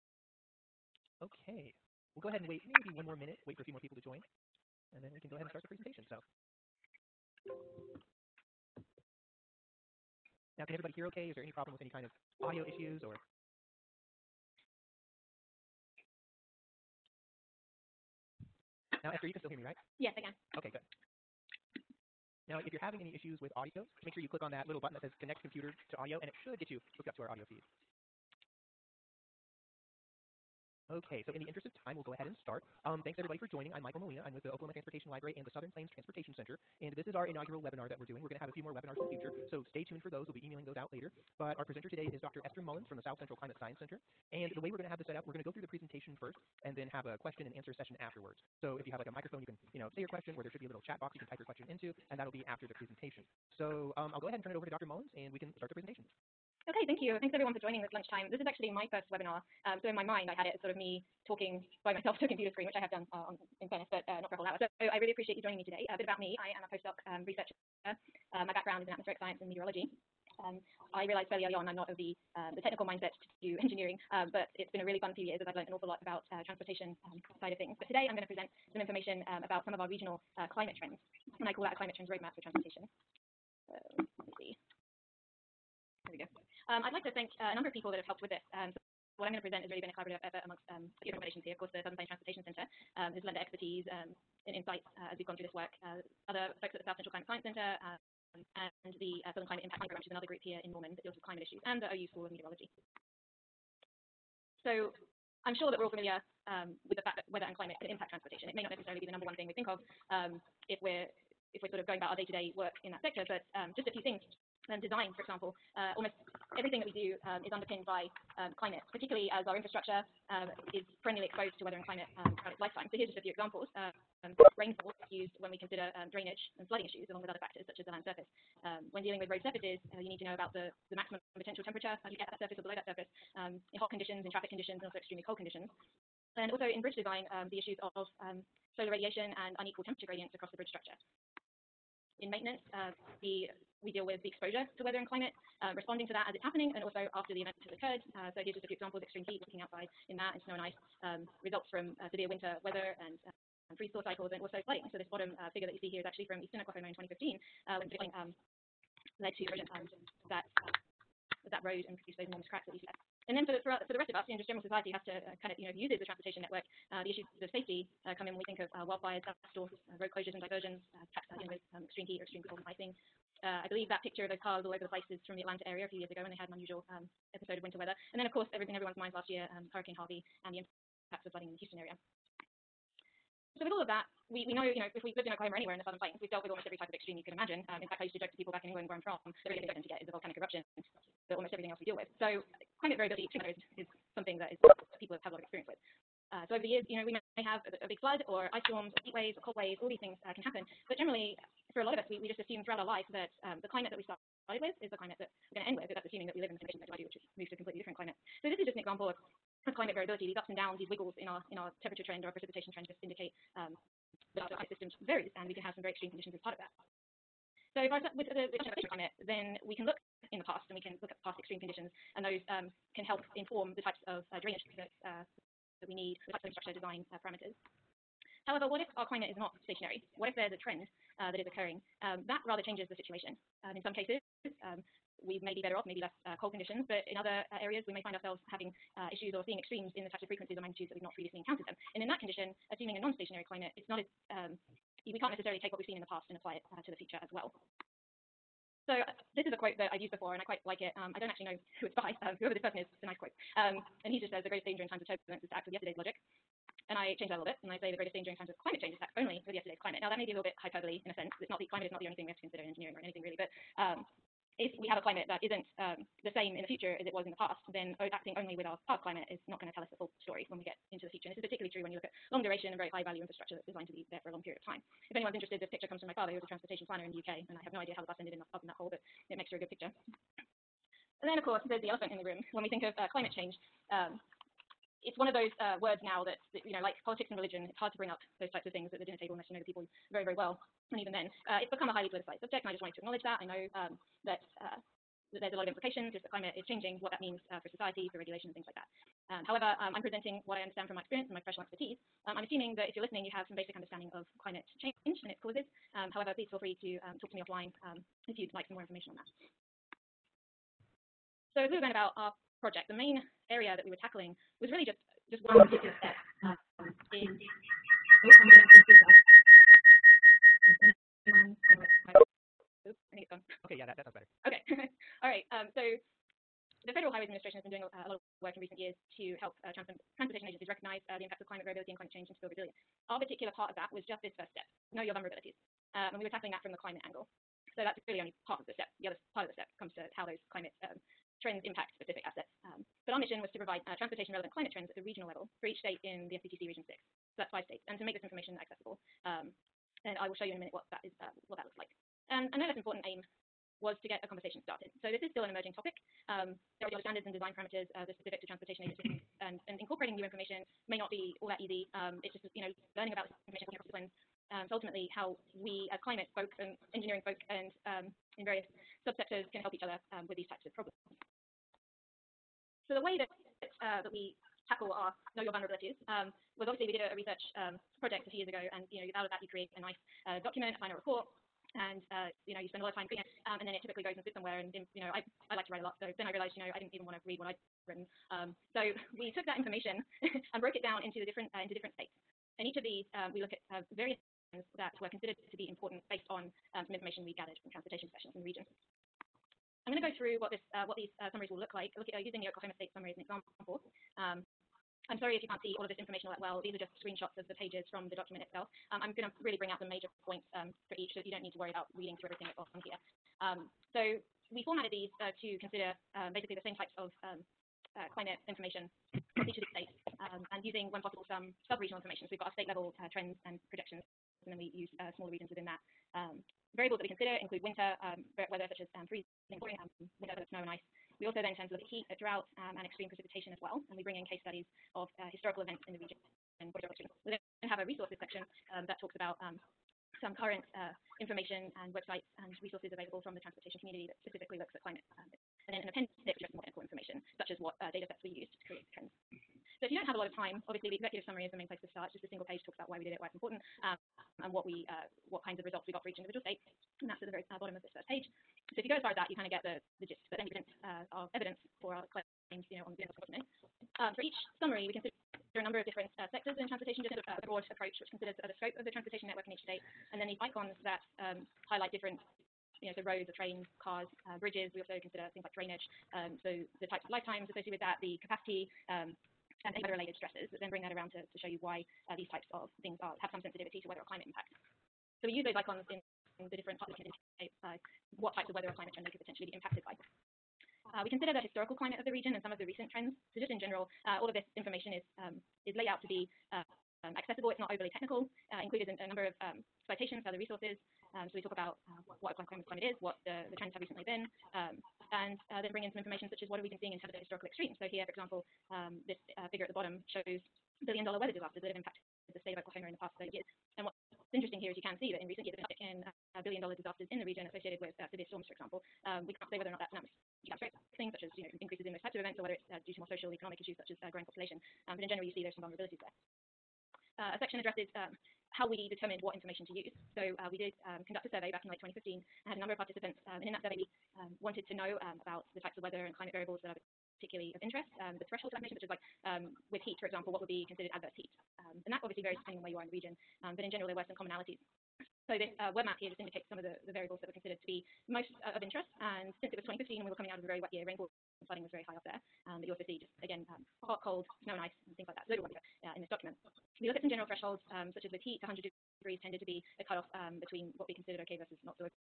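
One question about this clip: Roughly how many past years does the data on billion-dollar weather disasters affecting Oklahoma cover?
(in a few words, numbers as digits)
30.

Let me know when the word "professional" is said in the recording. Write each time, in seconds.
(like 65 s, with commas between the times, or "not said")
301 s, 398 s.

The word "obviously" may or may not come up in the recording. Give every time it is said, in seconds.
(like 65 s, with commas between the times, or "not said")
356 s, 376 s, 450 s, 542 s.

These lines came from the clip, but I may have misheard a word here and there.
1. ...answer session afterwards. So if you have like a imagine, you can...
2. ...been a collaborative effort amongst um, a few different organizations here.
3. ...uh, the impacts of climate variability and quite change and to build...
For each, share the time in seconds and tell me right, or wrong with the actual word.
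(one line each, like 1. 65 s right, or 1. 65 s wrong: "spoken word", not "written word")
1. 47 s wrong: "microphone", not "imagine"
2. 89 s right
3. 331 s wrong: "climate", not "quite".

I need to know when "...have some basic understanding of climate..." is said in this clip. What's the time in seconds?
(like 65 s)
303 s.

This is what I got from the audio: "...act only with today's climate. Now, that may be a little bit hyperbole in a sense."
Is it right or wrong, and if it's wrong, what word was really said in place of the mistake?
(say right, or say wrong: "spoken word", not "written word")
wrong: "yesterday", not "today".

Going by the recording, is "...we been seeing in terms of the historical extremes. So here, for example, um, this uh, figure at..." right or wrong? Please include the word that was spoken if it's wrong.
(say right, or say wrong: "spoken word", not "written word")
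right.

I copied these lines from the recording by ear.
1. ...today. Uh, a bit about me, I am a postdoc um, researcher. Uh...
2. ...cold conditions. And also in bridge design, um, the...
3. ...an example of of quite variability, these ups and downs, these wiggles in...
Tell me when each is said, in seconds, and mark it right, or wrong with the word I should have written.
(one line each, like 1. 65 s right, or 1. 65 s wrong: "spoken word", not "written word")
1. 65 s right
2. 135 s right
3. 208 s wrong: "climate", not "quite".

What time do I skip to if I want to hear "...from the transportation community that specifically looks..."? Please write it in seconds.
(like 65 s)
443 s.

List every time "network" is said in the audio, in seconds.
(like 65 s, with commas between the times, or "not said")
166 s, 469 s.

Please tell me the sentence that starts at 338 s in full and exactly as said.
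The other part of the step comes to how those climate um, trends impact specific assets.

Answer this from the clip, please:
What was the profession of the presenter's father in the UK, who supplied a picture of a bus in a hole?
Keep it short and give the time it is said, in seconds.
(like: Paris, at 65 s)
transportation planner, at 276 s.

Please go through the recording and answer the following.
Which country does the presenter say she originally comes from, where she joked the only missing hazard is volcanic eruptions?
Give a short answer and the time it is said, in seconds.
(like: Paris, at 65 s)
England, at 188 s.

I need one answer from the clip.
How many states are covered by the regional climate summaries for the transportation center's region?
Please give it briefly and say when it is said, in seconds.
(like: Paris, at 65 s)
5, at 347 s.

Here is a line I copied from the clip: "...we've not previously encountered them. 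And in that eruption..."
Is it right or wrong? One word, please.
wrong.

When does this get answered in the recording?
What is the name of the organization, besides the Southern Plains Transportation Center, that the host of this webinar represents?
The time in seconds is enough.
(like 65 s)
34 s.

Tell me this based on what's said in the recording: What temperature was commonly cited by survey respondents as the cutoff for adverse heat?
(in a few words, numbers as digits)
100 degrees.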